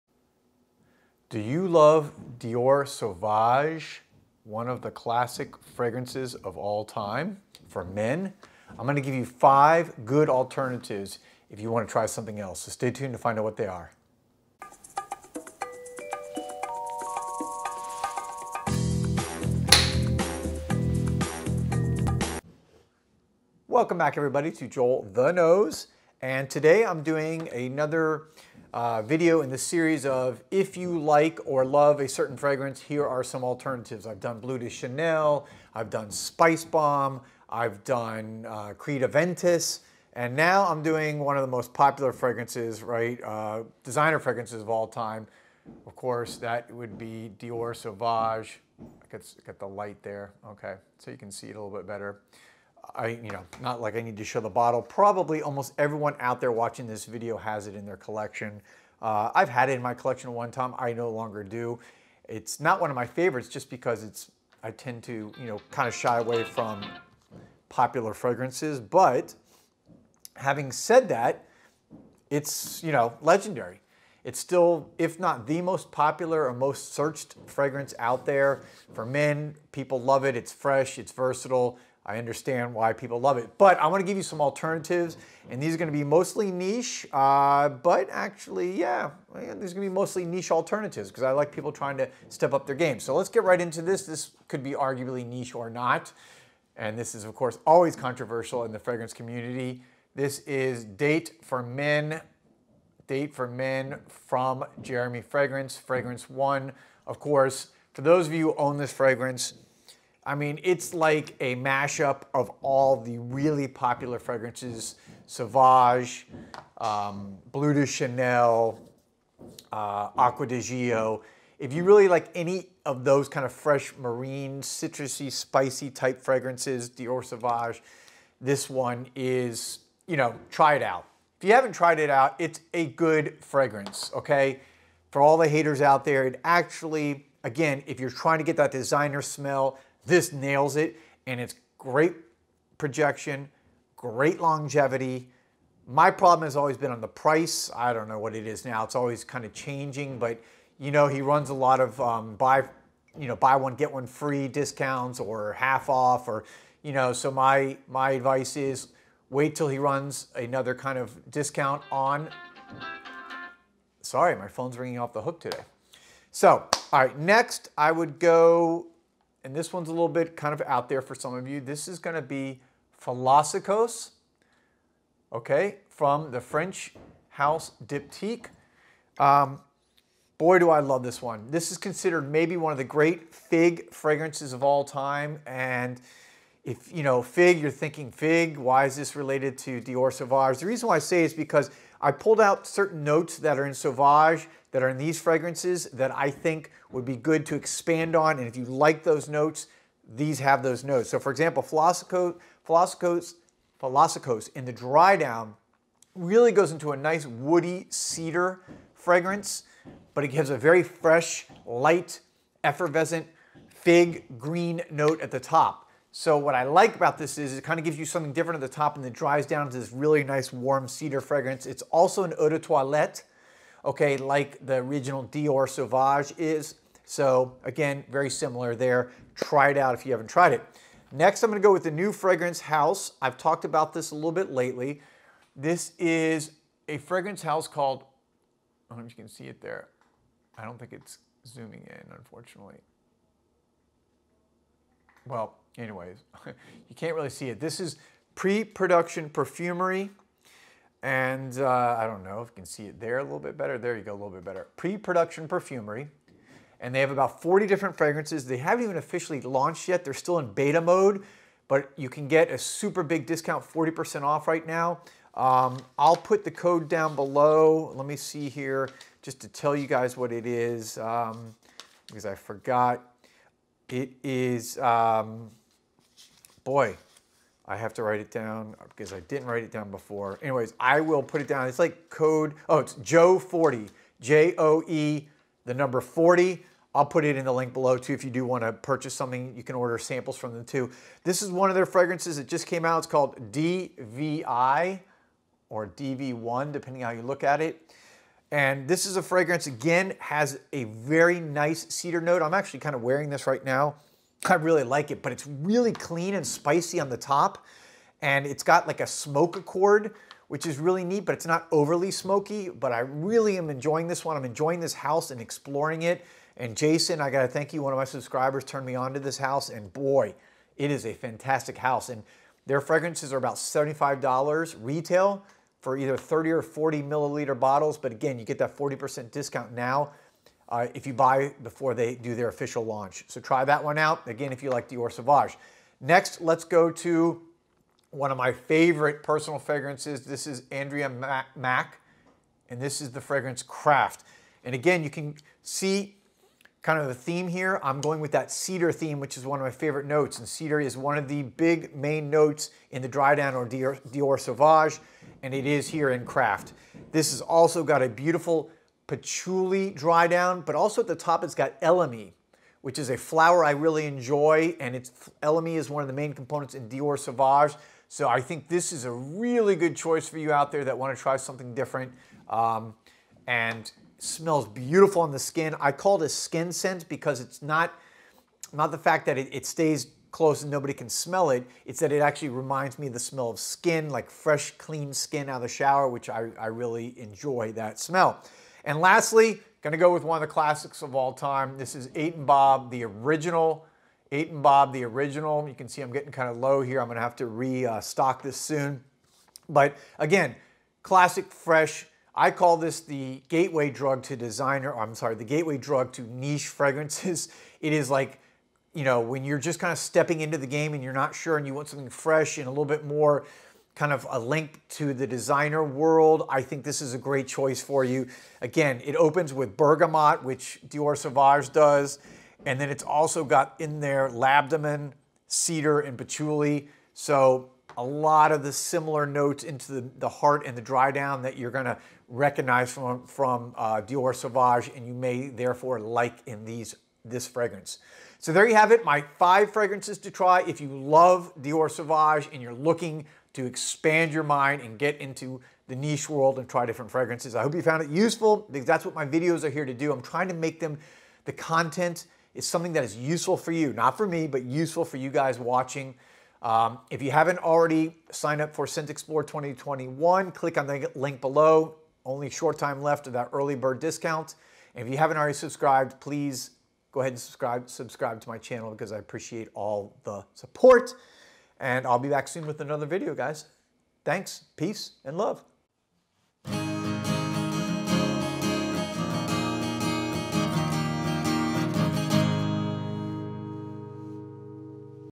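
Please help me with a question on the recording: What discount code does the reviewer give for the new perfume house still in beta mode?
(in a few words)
Joe40.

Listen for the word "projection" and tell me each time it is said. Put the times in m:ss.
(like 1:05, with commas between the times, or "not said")
2:22.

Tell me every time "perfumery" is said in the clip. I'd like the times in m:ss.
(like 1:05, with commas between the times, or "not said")
4:09, 4:15.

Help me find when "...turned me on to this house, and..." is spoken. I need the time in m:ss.
5:18.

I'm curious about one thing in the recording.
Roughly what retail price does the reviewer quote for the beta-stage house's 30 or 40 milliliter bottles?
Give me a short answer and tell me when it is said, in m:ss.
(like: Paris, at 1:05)
$75, at 5:23.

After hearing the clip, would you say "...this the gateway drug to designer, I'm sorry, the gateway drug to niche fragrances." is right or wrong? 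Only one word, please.
right.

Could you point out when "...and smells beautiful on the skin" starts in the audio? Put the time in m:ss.
6:13.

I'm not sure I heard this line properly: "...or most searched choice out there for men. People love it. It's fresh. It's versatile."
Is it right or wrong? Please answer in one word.
wrong.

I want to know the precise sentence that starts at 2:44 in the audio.
Sorry, my phone's ringing off the hook today.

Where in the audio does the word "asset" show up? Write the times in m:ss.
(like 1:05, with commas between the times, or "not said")
not said.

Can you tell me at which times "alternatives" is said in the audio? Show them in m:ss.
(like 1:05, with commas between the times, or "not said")
0:10, 0:33, 1:24, 1:30.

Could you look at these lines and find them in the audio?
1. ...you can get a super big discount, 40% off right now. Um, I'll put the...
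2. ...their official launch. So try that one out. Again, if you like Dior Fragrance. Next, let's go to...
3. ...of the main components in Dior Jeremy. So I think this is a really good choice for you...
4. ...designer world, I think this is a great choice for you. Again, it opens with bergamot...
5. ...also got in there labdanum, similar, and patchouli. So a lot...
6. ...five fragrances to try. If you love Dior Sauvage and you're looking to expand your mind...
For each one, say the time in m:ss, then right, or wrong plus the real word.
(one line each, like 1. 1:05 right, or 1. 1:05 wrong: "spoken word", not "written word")
1. 4:21 right
2. 5:32 wrong: "Sauvage", not "Fragrance"
3. 6:06 wrong: "Sauvage", not "Jeremy"
4. 6:55 right
5. 7:03 wrong: "cedar", not "similar"
6. 7:19 right.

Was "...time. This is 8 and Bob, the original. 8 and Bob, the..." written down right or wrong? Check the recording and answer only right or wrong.
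right.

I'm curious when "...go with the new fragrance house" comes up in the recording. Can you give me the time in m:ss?
3:51.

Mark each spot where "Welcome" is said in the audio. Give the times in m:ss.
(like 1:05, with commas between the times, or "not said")
0:23.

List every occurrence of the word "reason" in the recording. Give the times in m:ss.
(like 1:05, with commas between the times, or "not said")
3:10.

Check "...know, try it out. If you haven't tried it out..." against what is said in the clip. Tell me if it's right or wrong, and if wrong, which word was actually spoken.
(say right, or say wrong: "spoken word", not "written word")
right.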